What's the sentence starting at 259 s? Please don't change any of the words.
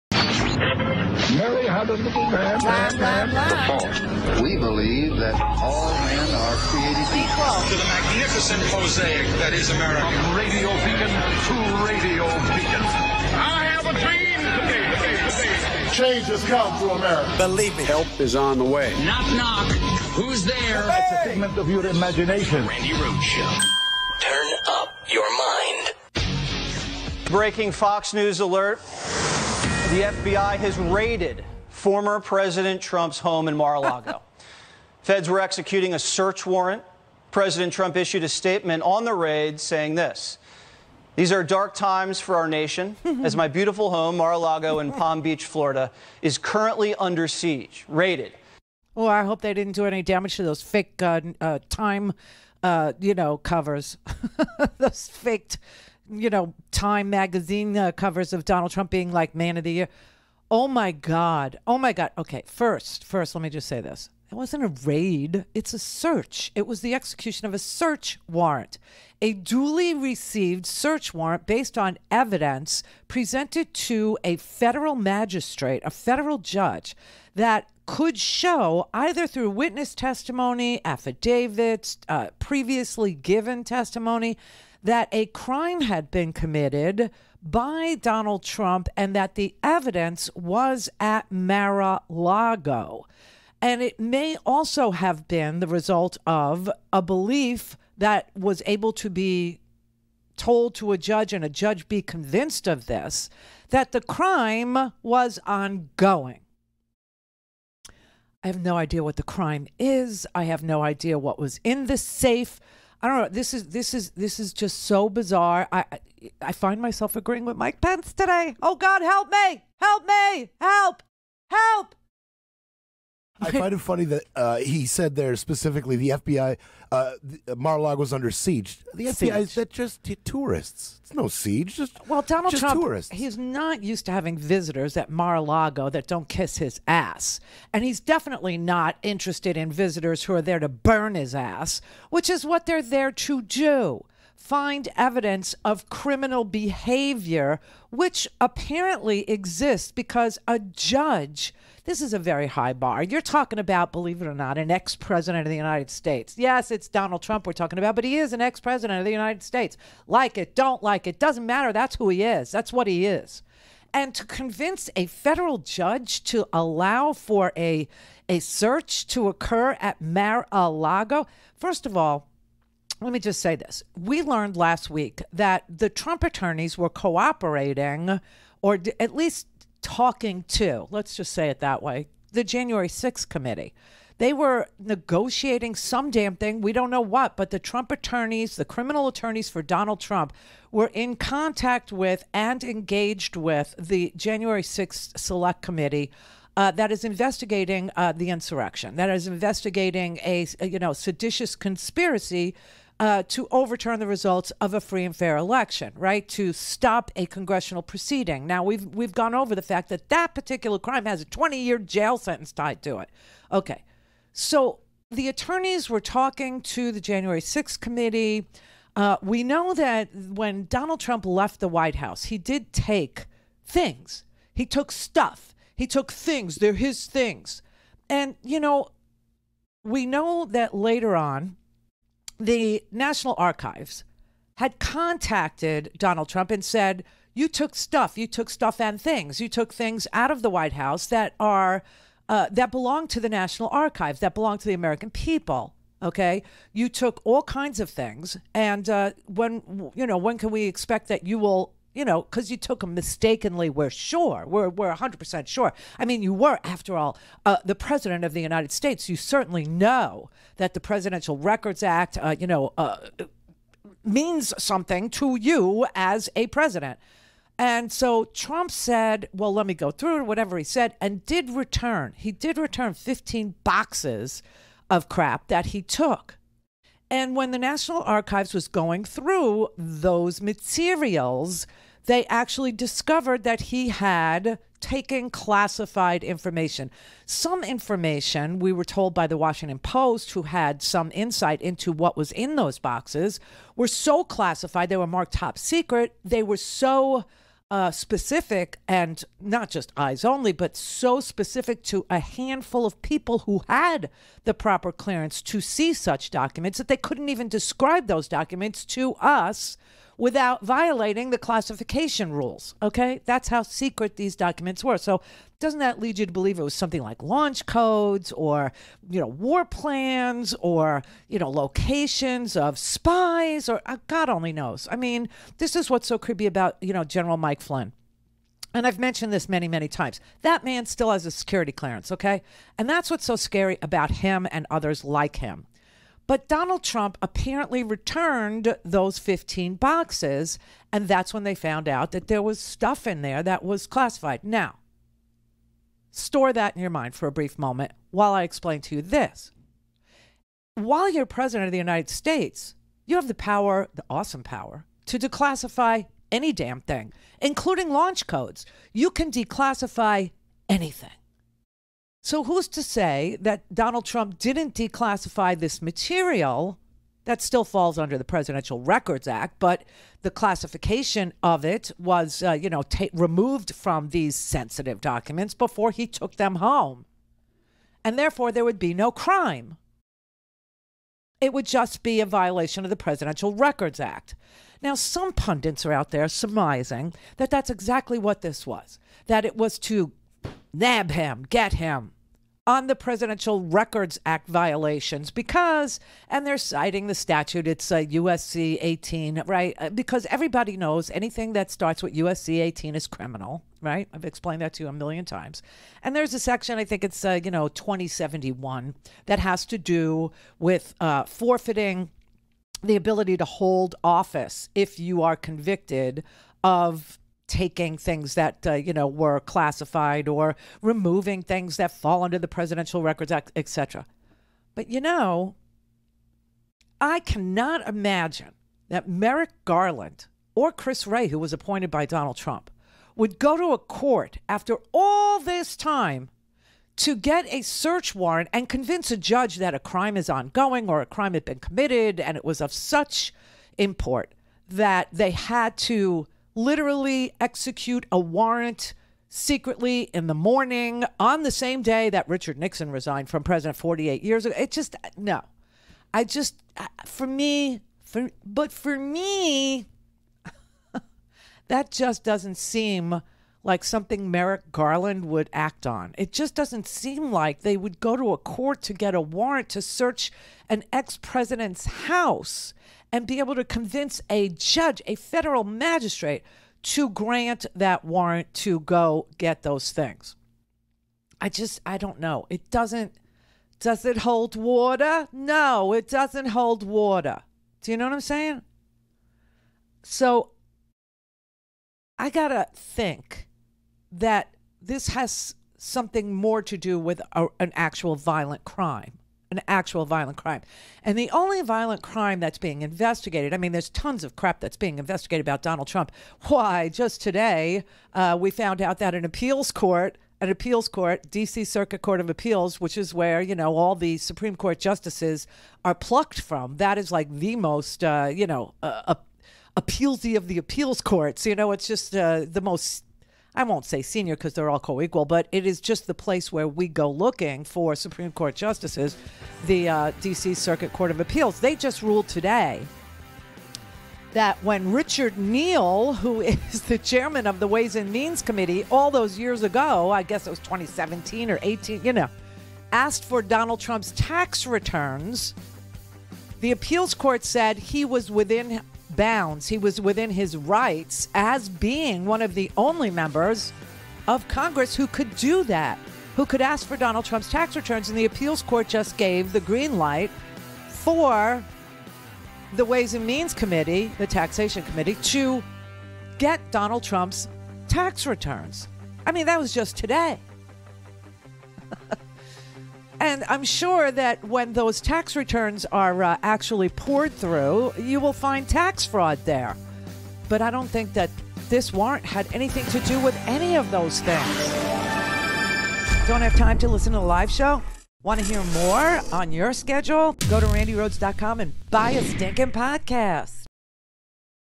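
You certainly know that the Presidential Records Act, uh, you know, uh, means something to you as a president.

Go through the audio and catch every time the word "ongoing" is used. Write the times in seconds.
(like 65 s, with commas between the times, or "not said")
105 s, 440 s.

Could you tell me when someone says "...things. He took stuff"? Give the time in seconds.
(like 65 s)
223 s.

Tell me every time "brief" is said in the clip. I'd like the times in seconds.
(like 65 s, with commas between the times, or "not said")
347 s.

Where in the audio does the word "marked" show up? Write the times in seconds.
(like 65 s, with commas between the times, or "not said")
295 s.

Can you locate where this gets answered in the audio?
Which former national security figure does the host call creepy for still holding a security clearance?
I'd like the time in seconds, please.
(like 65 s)
327 s.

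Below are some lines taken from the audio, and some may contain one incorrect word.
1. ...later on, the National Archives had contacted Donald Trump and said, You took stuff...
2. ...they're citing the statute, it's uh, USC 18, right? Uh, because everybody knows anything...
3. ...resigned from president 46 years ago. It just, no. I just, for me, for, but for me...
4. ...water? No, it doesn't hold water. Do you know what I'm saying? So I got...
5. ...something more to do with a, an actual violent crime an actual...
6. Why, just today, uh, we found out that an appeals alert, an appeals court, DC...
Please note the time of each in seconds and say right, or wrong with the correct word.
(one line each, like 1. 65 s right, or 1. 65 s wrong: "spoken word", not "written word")
1. 230 s right
2. 396 s right
3. 452 s wrong: "48", not "46"
4. 484 s right
5. 495 s right
6. 506 s wrong: "court", not "alert".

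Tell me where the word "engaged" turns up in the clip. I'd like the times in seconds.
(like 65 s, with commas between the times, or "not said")
192 s.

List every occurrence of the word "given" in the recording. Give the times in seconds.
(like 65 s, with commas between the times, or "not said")
83 s.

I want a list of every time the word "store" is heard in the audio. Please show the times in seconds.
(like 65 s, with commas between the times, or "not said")
346 s.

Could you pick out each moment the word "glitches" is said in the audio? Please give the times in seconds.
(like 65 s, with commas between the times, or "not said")
not said.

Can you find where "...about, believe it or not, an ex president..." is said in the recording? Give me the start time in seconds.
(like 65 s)
153 s.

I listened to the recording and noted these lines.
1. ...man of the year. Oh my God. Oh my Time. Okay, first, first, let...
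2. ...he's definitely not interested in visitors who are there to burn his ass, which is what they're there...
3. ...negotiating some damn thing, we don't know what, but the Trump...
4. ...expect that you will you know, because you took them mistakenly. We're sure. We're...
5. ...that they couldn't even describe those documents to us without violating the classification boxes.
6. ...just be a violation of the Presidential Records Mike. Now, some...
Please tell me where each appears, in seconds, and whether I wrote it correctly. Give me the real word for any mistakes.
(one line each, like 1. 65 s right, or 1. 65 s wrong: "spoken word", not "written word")
1. 59 s wrong: "God", not "Time"
2. 137 s right
3. 184 s right
4. 250 s right
5. 306 s wrong: "rules", not "boxes"
6. 381 s wrong: "Act", not "Mike".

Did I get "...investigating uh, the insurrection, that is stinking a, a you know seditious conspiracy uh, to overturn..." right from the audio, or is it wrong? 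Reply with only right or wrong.
wrong.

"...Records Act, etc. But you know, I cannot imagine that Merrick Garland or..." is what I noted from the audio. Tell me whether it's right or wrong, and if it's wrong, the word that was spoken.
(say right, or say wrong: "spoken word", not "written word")
right.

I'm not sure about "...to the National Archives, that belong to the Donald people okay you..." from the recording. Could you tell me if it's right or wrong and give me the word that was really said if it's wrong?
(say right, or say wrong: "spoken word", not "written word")
wrong: "American", not "Donald".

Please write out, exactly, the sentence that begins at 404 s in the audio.
I've explained that to you a million times.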